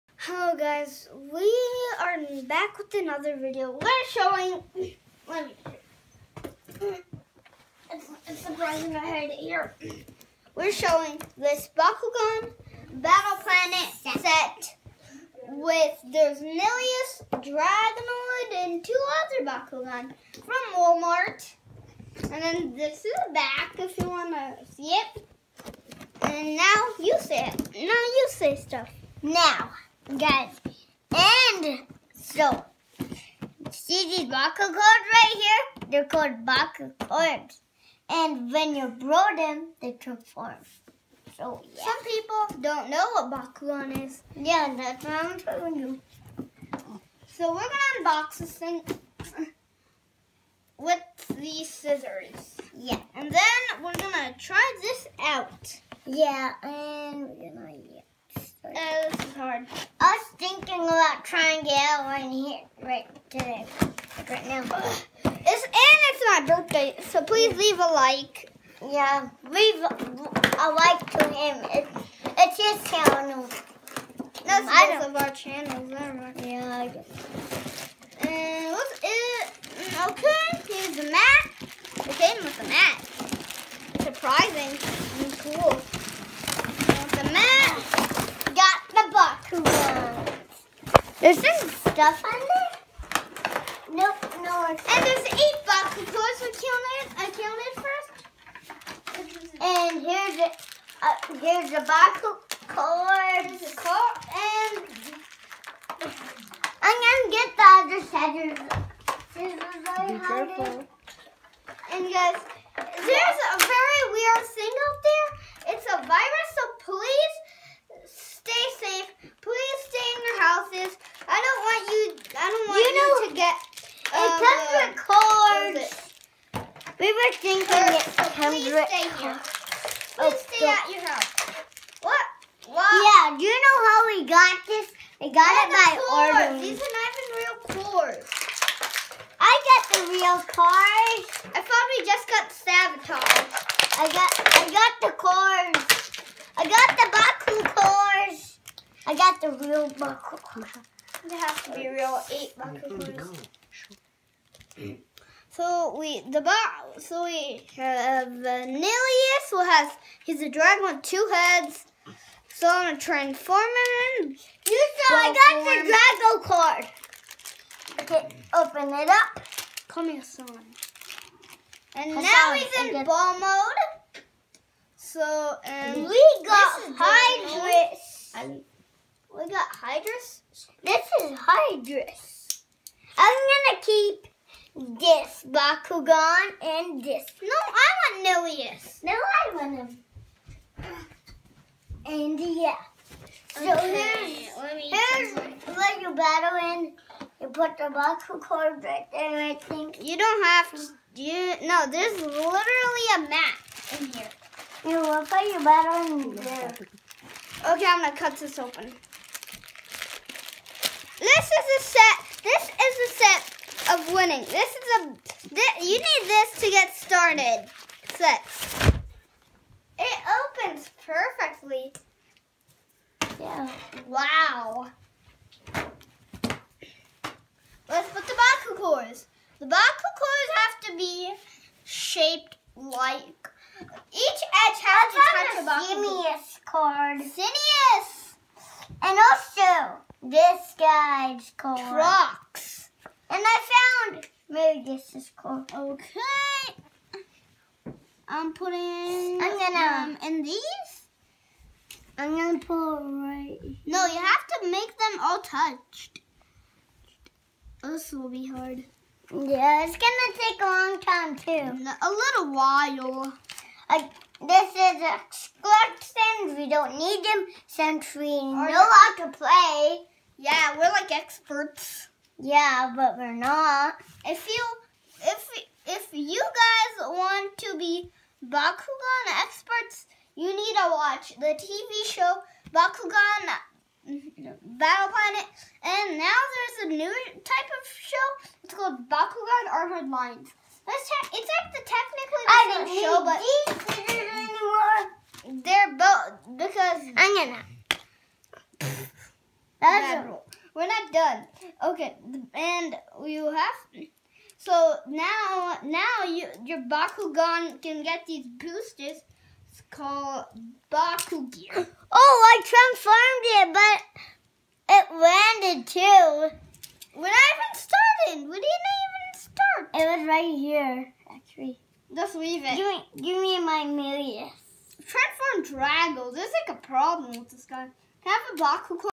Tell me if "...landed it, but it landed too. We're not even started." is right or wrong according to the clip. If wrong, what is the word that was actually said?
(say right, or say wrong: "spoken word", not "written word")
wrong: "transformed", not "landed".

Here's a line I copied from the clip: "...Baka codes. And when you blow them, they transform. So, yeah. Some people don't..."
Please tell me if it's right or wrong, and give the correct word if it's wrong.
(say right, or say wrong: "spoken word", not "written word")
right.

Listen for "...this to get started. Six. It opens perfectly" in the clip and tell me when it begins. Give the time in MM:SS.
03:36.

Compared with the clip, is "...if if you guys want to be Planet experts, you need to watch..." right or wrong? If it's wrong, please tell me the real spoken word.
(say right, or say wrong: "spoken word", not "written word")
wrong: "Bakugan", not "Planet".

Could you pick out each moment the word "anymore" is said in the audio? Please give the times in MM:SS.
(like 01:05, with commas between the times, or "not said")
04:55.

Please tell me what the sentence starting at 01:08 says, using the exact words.
Yeah, leave a like to him.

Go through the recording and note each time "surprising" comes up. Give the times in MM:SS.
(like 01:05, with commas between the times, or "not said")
00:08, 01:24.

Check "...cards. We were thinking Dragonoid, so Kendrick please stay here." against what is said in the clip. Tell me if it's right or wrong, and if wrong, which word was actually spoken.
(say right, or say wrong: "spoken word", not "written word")
wrong: "Kurt", not "Dragonoid".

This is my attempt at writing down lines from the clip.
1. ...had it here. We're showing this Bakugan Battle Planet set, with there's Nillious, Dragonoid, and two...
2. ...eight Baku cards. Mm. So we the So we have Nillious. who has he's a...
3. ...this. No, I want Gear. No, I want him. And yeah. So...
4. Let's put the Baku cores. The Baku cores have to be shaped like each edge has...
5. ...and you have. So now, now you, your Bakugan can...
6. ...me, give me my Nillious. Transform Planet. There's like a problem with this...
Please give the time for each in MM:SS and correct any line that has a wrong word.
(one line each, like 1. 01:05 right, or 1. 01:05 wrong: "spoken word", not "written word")
1. 00:09 right
2. 02:32 right
3. 03:07 wrong: "Nillious", not "Gear"
4. 03:47 right
5. 05:02 right
6. 05:22 wrong: "Drago", not "Planet".